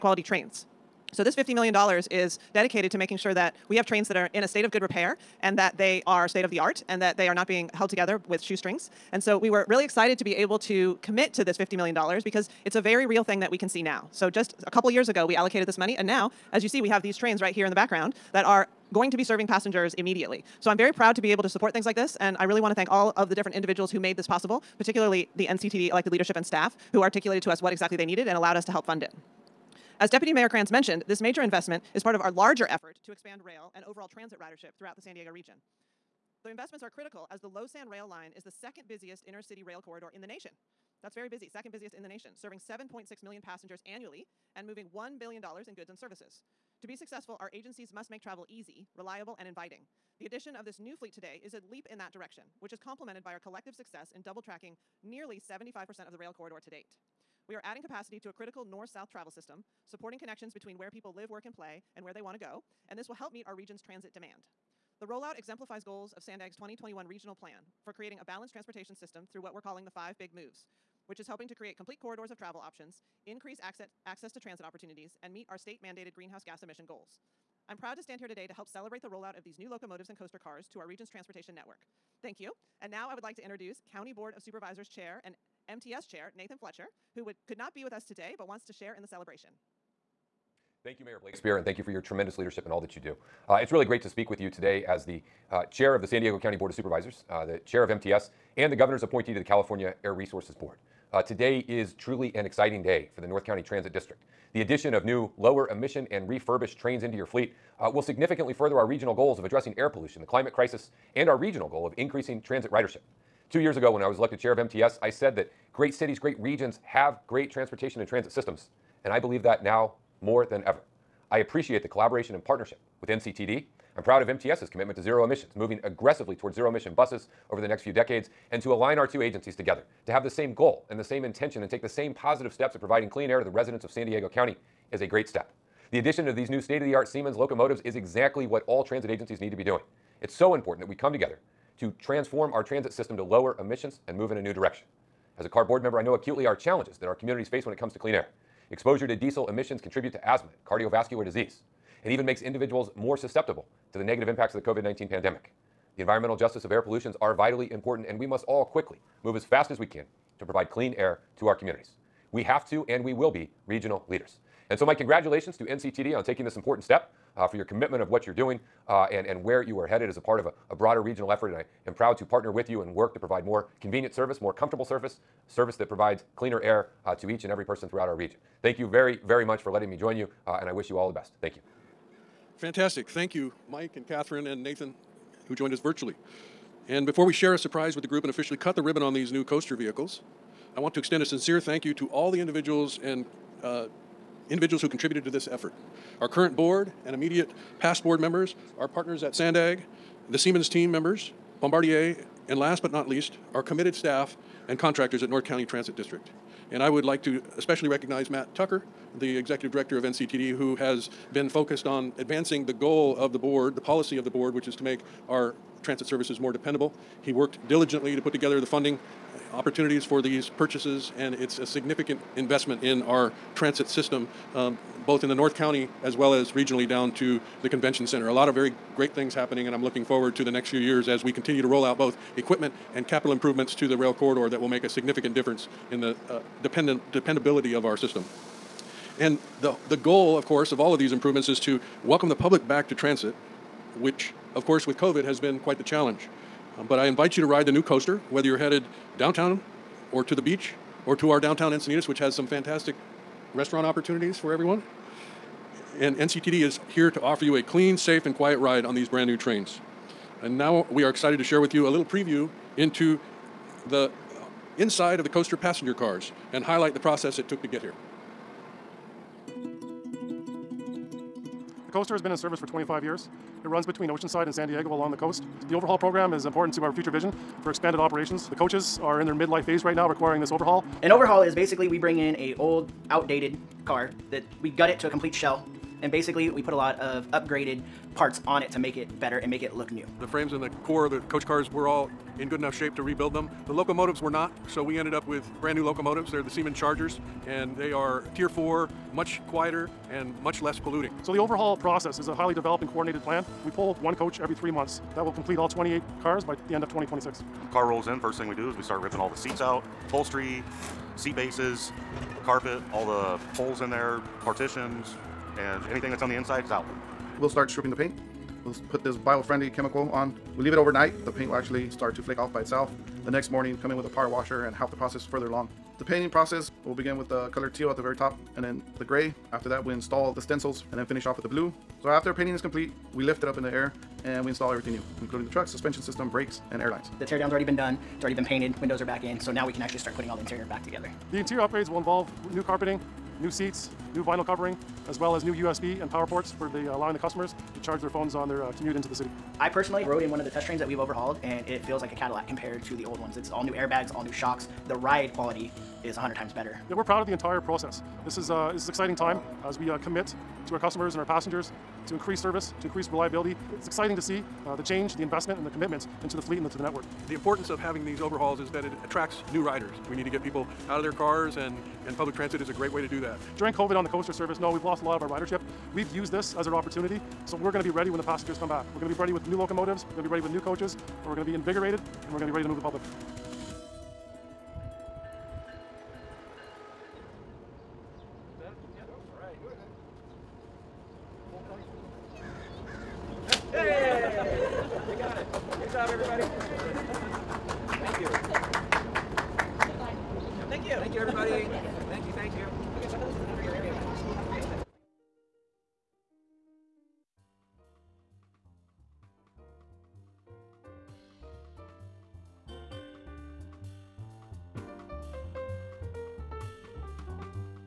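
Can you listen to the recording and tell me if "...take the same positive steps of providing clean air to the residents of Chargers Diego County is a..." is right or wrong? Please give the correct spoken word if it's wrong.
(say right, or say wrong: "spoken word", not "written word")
wrong: "San", not "Chargers".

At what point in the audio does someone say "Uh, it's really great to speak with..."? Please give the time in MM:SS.
01:33.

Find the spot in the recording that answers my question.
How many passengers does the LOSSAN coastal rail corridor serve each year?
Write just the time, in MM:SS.
00:42.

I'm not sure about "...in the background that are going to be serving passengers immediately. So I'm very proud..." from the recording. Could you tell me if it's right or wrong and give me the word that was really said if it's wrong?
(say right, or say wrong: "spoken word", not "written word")
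right.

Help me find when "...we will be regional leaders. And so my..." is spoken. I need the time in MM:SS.
02:43.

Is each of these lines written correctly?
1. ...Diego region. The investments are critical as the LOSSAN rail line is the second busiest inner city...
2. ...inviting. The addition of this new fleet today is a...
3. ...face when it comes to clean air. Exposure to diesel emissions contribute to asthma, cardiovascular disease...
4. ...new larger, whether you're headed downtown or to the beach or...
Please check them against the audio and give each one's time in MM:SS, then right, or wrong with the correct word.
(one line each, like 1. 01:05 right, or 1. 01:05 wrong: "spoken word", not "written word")
1. 00:35 right
2. 00:49 right
3. 02:27 right
4. 04:07 wrong: "coaster", not "larger".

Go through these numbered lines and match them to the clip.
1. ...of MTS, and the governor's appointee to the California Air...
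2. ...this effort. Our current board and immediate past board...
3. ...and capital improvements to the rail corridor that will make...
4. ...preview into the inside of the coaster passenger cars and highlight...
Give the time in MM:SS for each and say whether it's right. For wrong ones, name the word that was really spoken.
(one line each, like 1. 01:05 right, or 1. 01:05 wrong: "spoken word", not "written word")
1. 01:37 right
2. 03:15 right
3. 03:52 right
4. 04:22 right.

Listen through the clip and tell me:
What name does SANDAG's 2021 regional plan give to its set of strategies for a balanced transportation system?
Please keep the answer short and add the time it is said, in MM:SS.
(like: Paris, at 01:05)
five big moves, at 01:09.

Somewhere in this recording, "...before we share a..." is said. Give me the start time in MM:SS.
03:07.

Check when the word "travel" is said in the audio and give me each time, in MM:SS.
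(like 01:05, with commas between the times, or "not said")
00:48, 00:59, 01:12.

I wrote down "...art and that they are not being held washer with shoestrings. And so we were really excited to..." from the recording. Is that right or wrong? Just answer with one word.
wrong.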